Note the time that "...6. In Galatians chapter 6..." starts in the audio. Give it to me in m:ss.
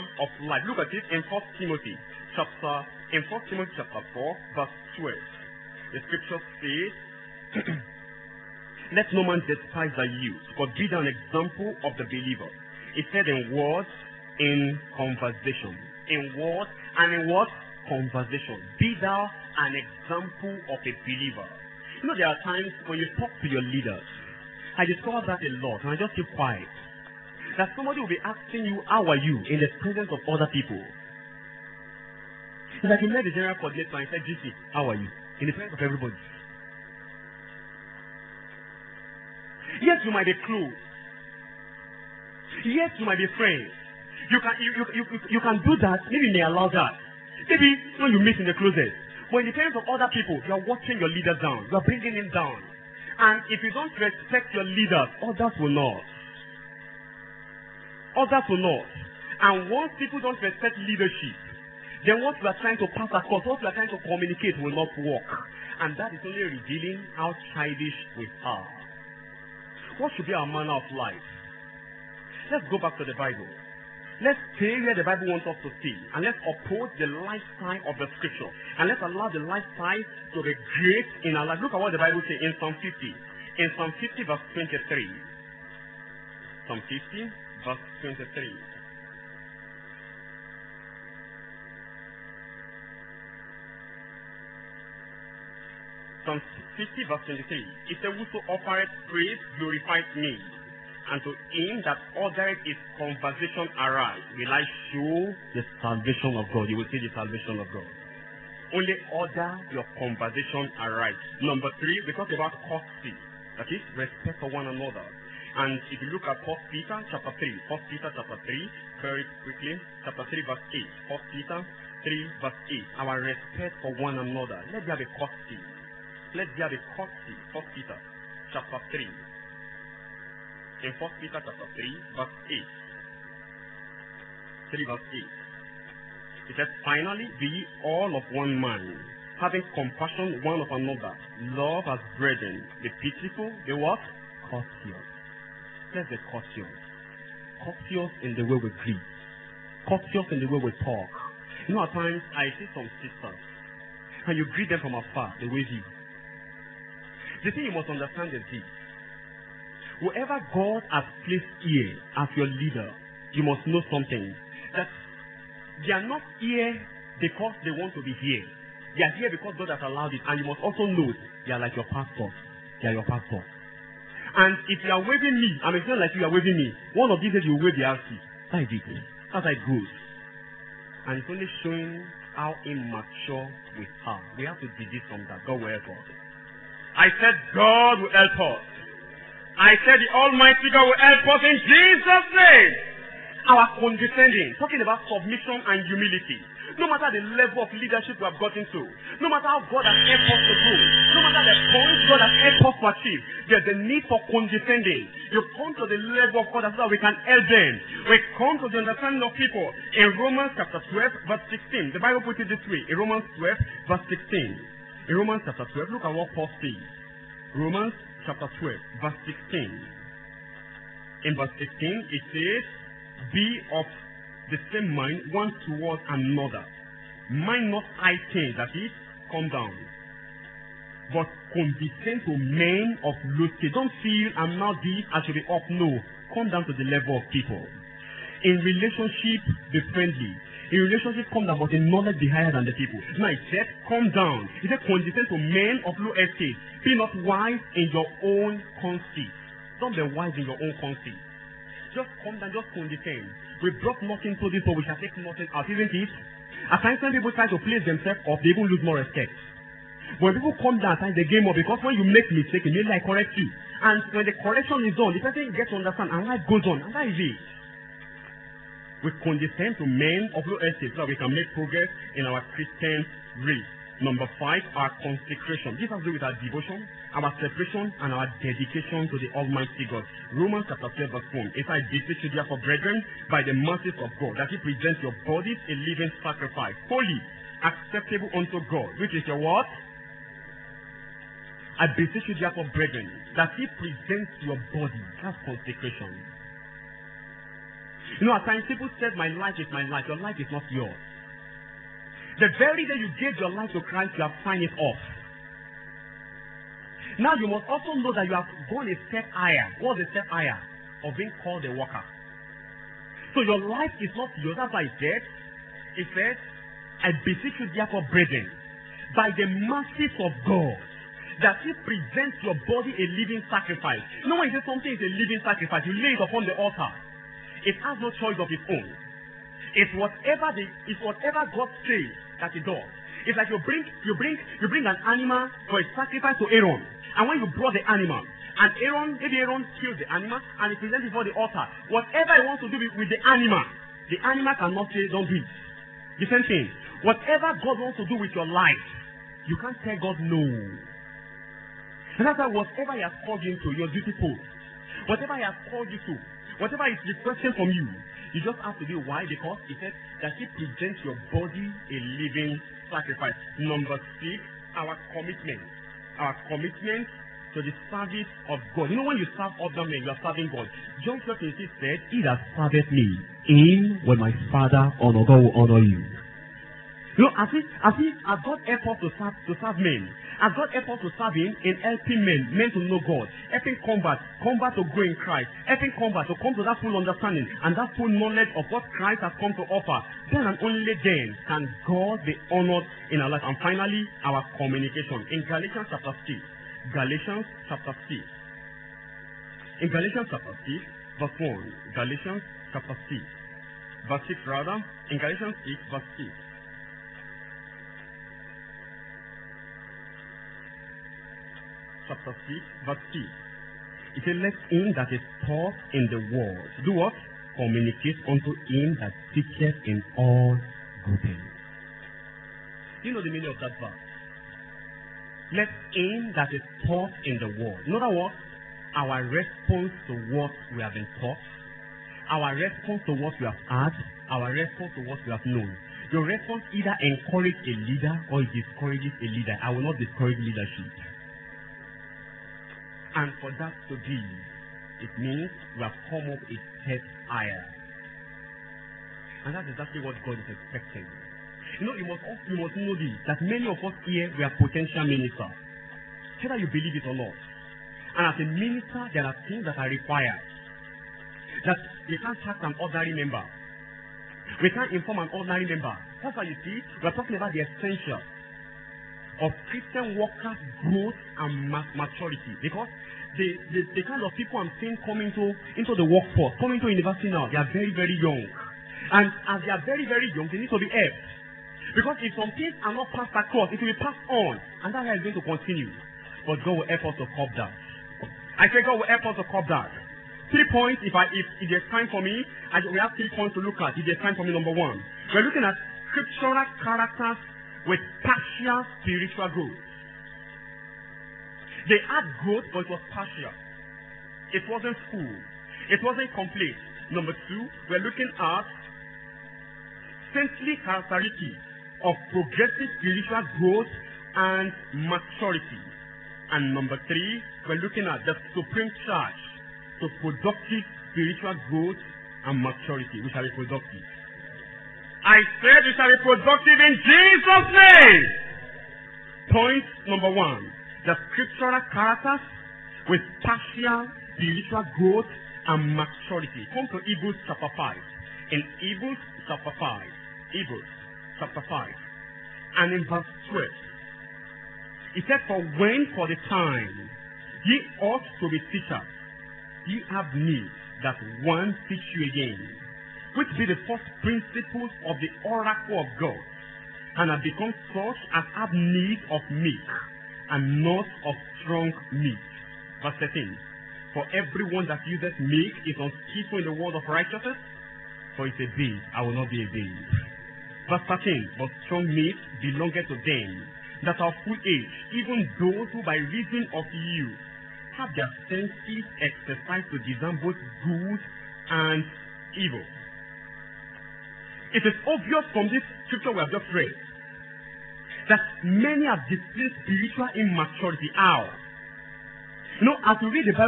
6:38.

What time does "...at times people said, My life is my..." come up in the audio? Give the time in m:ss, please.
4:58.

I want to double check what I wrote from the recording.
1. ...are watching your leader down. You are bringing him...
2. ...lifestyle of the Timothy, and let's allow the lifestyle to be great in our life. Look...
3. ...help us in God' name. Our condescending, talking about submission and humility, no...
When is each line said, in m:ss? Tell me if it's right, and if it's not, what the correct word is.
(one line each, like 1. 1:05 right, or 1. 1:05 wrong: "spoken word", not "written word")
1. 0:50 right
2. 1:17 wrong: "Scripture", not "Timothy"
3. 3:11 wrong: "Jesus", not "God".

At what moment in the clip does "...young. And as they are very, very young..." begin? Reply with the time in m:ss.
7:58.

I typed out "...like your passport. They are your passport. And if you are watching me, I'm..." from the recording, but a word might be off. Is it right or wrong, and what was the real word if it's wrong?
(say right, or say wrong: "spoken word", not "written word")
wrong: "waving", not "watching".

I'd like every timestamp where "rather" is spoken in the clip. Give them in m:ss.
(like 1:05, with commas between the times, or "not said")
6:44.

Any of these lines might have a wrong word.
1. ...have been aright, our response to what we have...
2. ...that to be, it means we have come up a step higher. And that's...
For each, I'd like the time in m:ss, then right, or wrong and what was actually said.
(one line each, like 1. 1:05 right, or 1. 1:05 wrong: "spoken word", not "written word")
1. 7:10 wrong: "taught", not "aright"
2. 7:23 right.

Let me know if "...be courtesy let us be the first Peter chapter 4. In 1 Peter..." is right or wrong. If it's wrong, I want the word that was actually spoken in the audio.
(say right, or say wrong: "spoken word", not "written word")
wrong: "3", not "4".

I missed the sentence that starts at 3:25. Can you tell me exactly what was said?
You come to the level of God that we can help them.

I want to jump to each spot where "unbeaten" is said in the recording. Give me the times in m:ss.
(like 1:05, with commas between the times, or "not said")
not said.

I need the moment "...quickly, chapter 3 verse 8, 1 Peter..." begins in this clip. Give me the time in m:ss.
1:59.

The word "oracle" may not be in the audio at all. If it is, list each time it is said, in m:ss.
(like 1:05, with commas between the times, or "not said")
9:15.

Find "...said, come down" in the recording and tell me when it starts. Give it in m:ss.
4:03.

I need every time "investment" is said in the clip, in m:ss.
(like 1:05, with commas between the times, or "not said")
not said.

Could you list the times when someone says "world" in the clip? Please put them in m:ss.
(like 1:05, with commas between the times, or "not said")
6:56, 7:07.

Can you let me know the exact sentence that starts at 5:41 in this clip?
Whatever he wants to do with the animal, the animal cannot say don't do it.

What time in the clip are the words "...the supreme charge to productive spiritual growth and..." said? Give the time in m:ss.
8:38.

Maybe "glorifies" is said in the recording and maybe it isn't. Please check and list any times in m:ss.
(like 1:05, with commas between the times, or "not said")
1:39.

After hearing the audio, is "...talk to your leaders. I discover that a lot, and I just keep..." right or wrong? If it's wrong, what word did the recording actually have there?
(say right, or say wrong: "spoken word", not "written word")
right.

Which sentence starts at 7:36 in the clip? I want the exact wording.
Whether you believe it or not.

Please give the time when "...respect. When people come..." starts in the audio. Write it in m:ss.
4:18.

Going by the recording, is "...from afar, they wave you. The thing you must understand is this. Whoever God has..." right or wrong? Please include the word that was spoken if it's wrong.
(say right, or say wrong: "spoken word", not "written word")
right.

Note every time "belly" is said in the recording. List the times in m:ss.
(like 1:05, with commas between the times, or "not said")
not said.